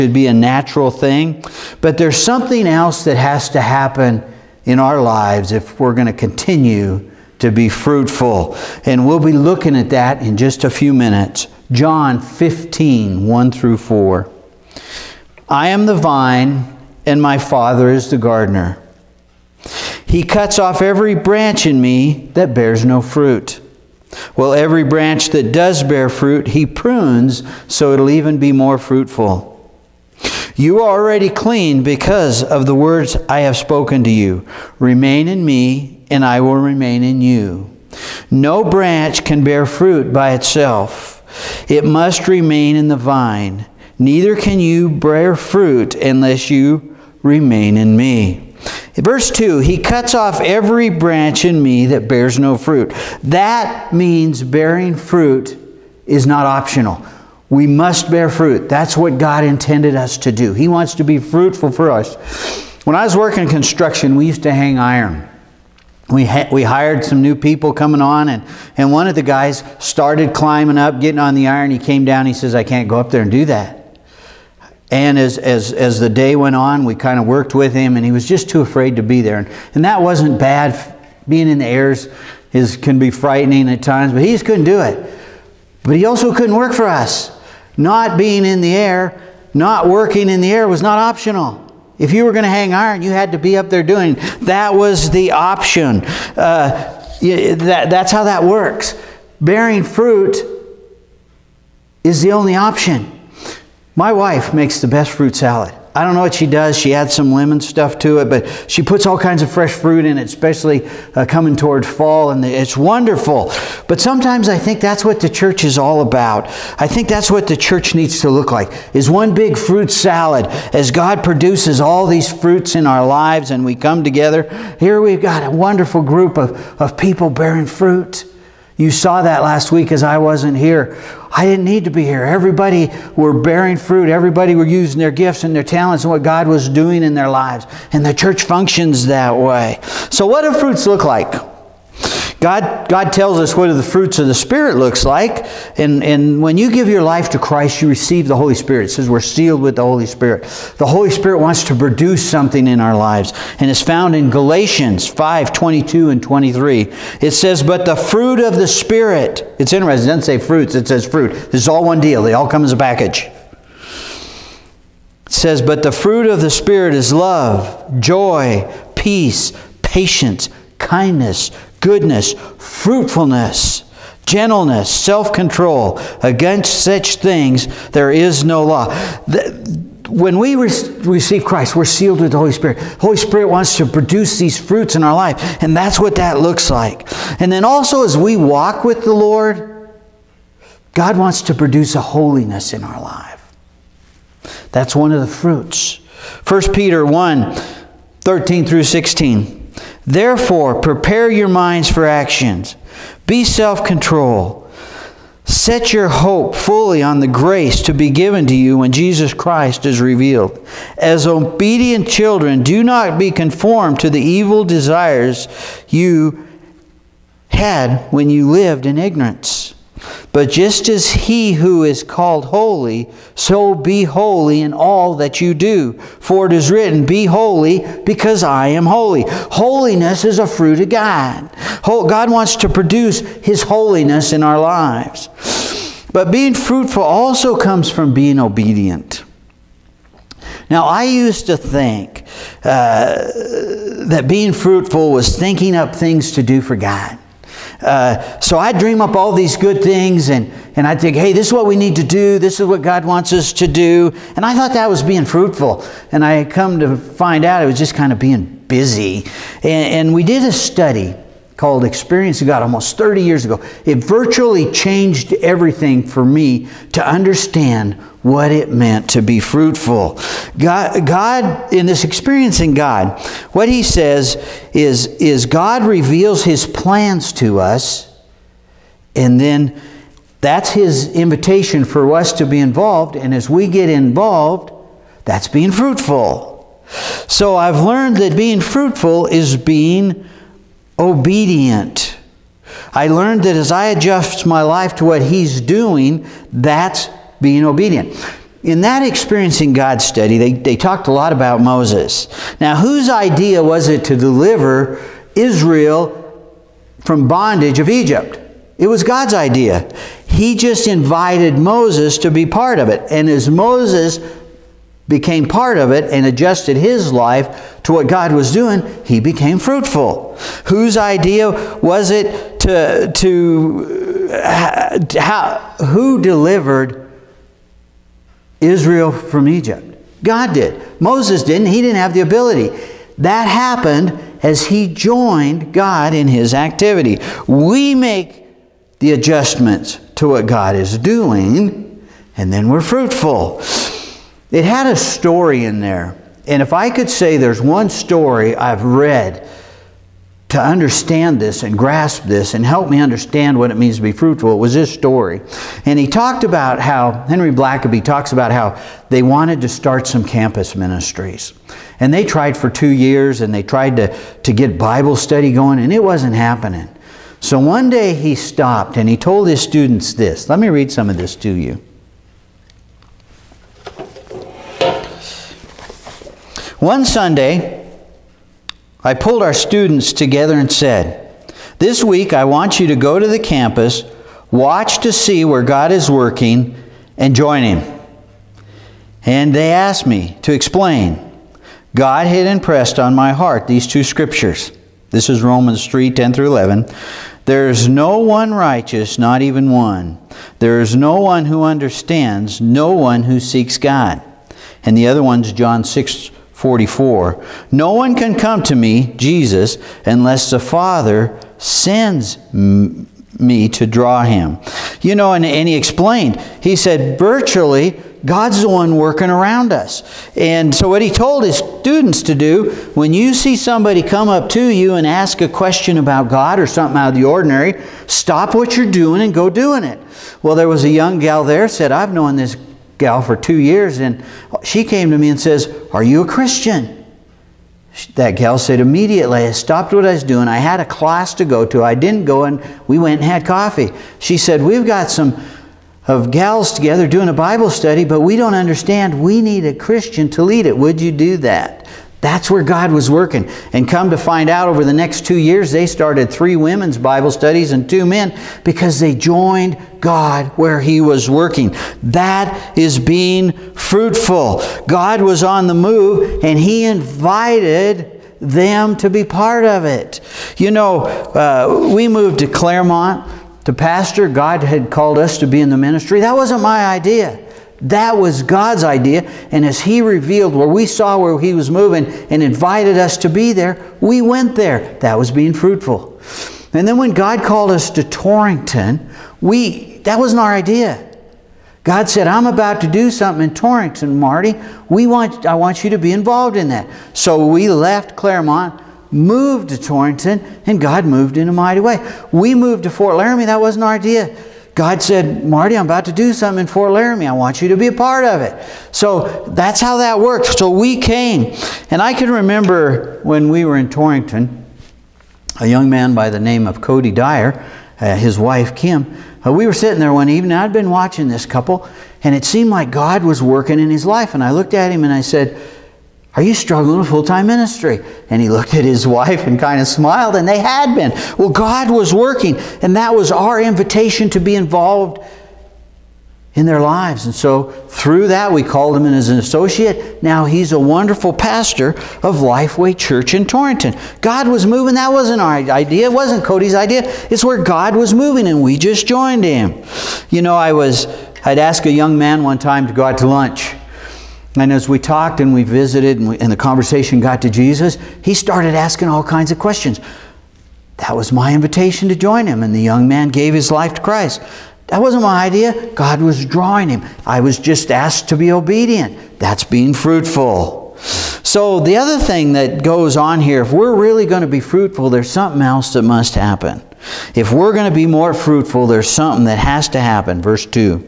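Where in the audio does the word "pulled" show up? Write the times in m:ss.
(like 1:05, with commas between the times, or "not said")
6:19.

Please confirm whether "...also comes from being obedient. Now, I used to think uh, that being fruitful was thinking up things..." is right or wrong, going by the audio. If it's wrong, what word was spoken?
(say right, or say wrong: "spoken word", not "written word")
right.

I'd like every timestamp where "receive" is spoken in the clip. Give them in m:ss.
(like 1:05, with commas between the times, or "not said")
2:27, 3:00.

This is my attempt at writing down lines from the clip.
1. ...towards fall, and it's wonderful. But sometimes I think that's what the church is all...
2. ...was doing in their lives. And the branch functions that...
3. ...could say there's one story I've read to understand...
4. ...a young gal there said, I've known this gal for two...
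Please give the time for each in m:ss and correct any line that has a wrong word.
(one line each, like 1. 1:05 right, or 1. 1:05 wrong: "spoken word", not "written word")
1. 1:51 right
2. 2:16 wrong: "church", not "branch"
3. 5:46 right
4. 7:10 right.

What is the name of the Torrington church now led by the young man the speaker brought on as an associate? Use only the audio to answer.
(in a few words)
Lifeway Church.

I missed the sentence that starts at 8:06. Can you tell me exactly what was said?
And then when God called us to Torrington, we that wasn't our idea.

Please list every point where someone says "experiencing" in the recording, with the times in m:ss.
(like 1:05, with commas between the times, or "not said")
4:21, 4:32, 4:59.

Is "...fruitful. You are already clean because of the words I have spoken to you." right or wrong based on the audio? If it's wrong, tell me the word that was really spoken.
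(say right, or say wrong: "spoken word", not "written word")
right.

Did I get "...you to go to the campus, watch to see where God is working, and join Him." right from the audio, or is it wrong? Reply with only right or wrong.
right.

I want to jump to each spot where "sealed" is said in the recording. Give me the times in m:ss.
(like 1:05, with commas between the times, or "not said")
2:29, 3:01.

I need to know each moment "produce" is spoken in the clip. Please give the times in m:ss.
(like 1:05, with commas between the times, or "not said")
2:01, 2:31, 3:03, 3:11, 3:52.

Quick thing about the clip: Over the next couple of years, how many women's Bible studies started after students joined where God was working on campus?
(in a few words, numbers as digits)
3.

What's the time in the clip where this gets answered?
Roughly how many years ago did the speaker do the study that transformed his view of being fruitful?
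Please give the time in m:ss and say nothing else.
4:22.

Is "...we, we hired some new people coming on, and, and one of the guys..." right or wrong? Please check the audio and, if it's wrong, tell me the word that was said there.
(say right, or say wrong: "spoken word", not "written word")
right.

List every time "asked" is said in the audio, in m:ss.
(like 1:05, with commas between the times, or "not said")
6:29, 9:27.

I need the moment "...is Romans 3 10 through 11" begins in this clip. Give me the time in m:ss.
6:35.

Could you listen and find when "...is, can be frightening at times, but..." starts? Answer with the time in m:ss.
1:22.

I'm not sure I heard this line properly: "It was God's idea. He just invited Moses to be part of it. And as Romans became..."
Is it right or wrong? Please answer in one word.
wrong.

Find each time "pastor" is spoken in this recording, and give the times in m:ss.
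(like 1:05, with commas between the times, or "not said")
7:53, 9:01.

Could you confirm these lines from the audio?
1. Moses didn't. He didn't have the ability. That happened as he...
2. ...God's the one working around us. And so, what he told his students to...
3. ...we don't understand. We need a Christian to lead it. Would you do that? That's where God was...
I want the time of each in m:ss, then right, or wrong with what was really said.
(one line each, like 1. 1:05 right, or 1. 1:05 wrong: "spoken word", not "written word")
1. 5:31 right
2. 6:58 right
3. 7:28 right.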